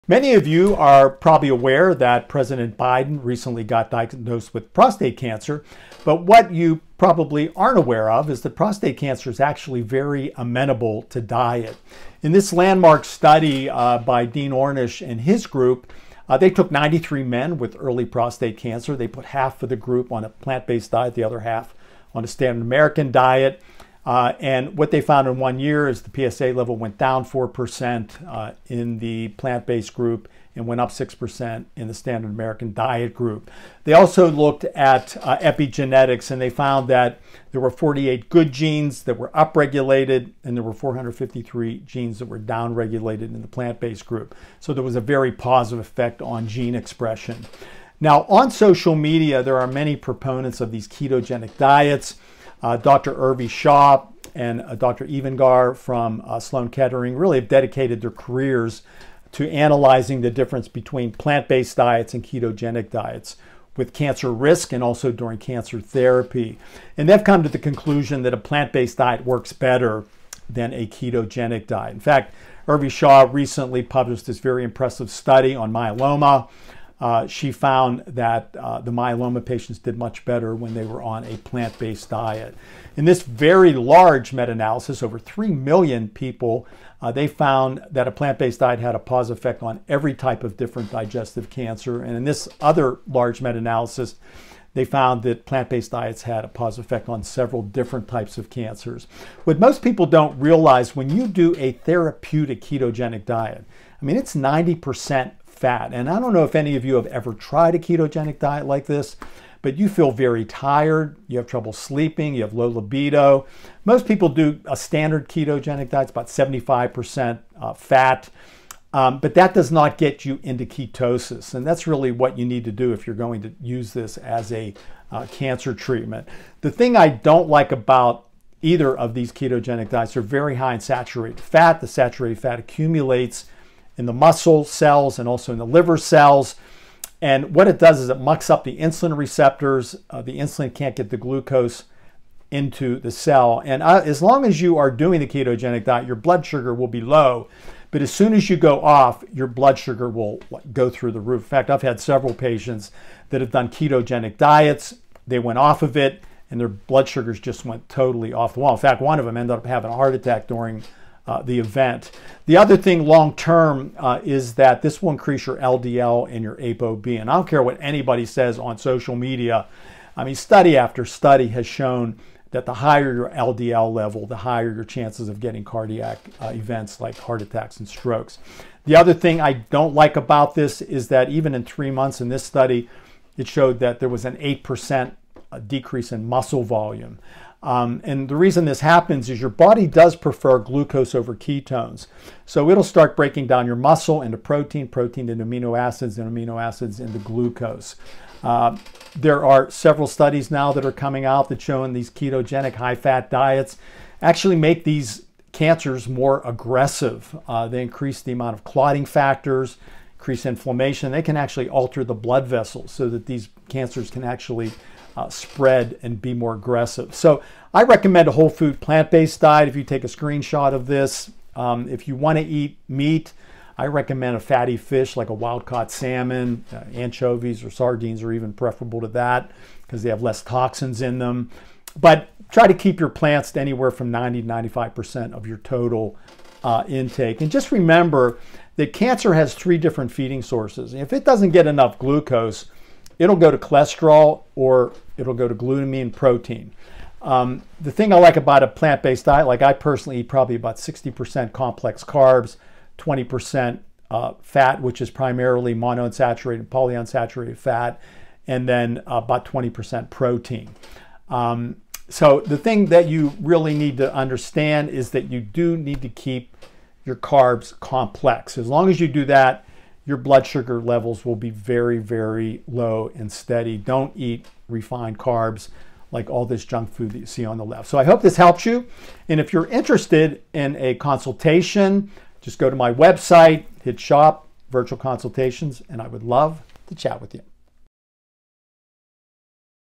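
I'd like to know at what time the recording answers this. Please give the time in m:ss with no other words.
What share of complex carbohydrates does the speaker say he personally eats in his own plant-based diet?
4:10.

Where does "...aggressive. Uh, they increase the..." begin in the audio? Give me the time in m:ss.
3:26.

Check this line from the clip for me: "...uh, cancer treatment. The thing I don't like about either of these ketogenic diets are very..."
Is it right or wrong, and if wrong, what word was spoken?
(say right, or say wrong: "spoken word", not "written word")
right.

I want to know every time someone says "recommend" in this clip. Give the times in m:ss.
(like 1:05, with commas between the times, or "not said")
3:37, 3:43.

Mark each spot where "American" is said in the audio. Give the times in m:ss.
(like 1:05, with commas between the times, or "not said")
0:22, 0:32.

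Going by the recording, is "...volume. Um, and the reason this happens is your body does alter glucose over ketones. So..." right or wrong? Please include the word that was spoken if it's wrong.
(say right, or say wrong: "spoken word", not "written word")
wrong: "prefer", not "alter".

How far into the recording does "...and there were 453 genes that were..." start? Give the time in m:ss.
0:40.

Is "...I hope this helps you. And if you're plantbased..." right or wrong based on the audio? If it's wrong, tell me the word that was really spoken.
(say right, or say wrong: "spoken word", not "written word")
wrong: "interested", not "plantbased".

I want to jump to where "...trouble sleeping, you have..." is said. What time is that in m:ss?
1:51.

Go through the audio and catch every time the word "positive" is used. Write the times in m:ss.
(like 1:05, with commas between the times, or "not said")
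0:45, 1:28, 1:36.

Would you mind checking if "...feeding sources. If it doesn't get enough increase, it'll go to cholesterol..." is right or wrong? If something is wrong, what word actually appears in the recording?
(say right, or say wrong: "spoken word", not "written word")
wrong: "glucose", not "increase".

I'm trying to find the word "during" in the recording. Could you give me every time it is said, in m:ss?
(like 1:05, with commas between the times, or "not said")
1:05, 2:40.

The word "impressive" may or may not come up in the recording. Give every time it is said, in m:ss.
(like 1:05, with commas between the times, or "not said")
1:14.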